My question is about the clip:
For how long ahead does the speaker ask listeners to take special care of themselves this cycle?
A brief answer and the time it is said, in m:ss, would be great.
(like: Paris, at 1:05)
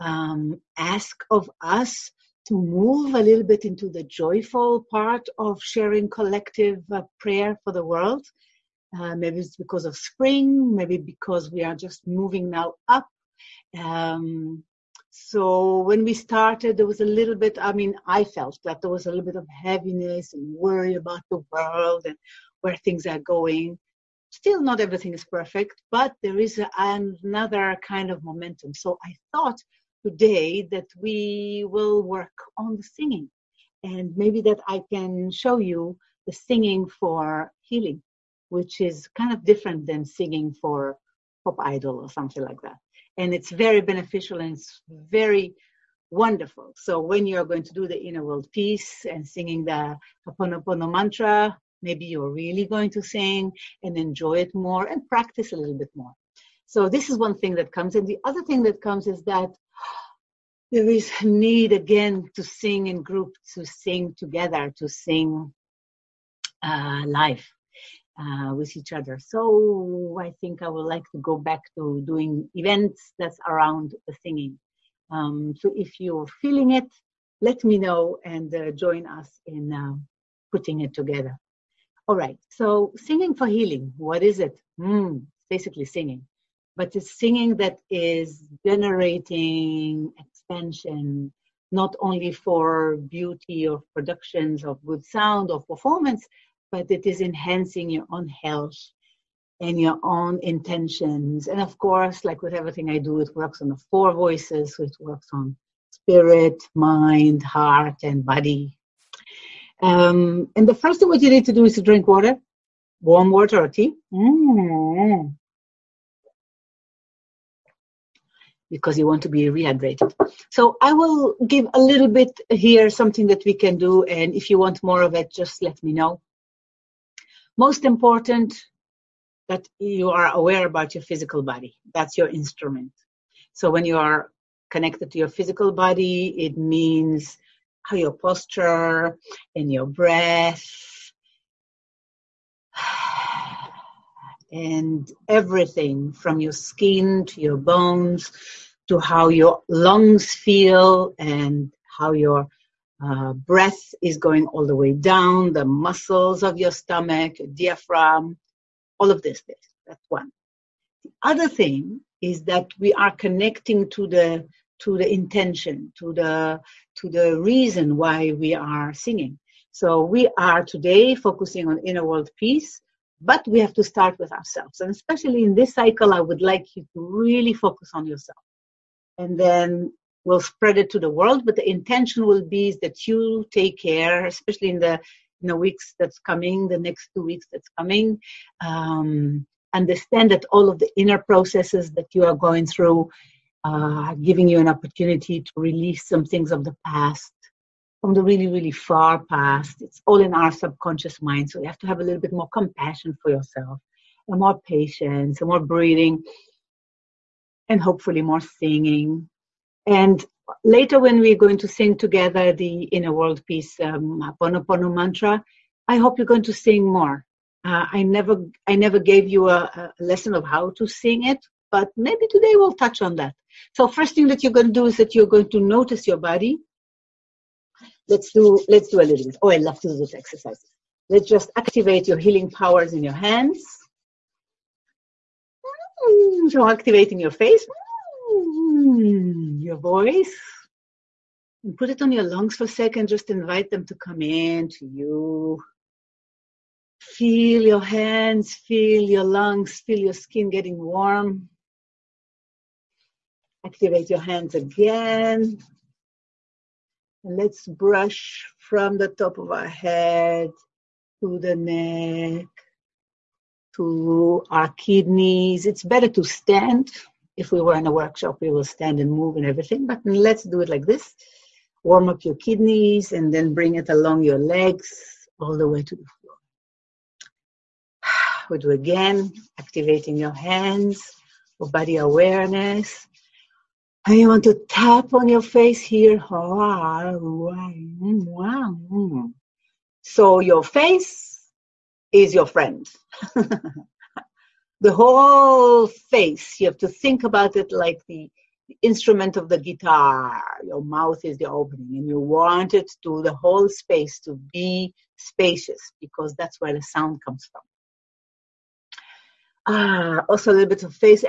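Two weeks, at 3:06.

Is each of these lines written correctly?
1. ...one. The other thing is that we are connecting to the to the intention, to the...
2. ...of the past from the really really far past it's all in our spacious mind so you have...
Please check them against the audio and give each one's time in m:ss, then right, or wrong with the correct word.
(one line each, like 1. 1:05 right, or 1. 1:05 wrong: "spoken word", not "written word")
1. 2:40 right
2. 3:16 wrong: "subconscious", not "spacious".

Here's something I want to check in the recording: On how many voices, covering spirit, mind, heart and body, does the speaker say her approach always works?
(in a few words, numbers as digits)
4.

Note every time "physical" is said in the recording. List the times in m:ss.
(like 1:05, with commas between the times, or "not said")
2:11, 2:15.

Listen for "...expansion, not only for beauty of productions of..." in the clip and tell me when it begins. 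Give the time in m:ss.
1:30.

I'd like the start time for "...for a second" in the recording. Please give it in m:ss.
4:02.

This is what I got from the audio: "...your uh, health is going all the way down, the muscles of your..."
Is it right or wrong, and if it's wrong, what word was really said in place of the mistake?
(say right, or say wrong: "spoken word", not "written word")
wrong: "breath", not "health".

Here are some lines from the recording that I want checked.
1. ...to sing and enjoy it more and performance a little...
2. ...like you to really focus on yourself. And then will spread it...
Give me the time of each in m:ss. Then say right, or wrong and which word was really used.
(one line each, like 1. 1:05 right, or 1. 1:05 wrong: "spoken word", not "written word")
1. 0:52 wrong: "practice", not "performance"
2. 2:56 right.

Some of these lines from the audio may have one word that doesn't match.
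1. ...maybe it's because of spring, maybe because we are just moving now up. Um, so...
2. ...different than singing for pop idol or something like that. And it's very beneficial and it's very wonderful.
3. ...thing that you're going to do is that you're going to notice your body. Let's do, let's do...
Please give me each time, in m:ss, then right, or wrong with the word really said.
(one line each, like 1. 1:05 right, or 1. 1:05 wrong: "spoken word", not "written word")
1. 0:09 right
2. 0:39 right
3. 3:44 right.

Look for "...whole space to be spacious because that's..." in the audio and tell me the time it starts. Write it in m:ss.
5:03.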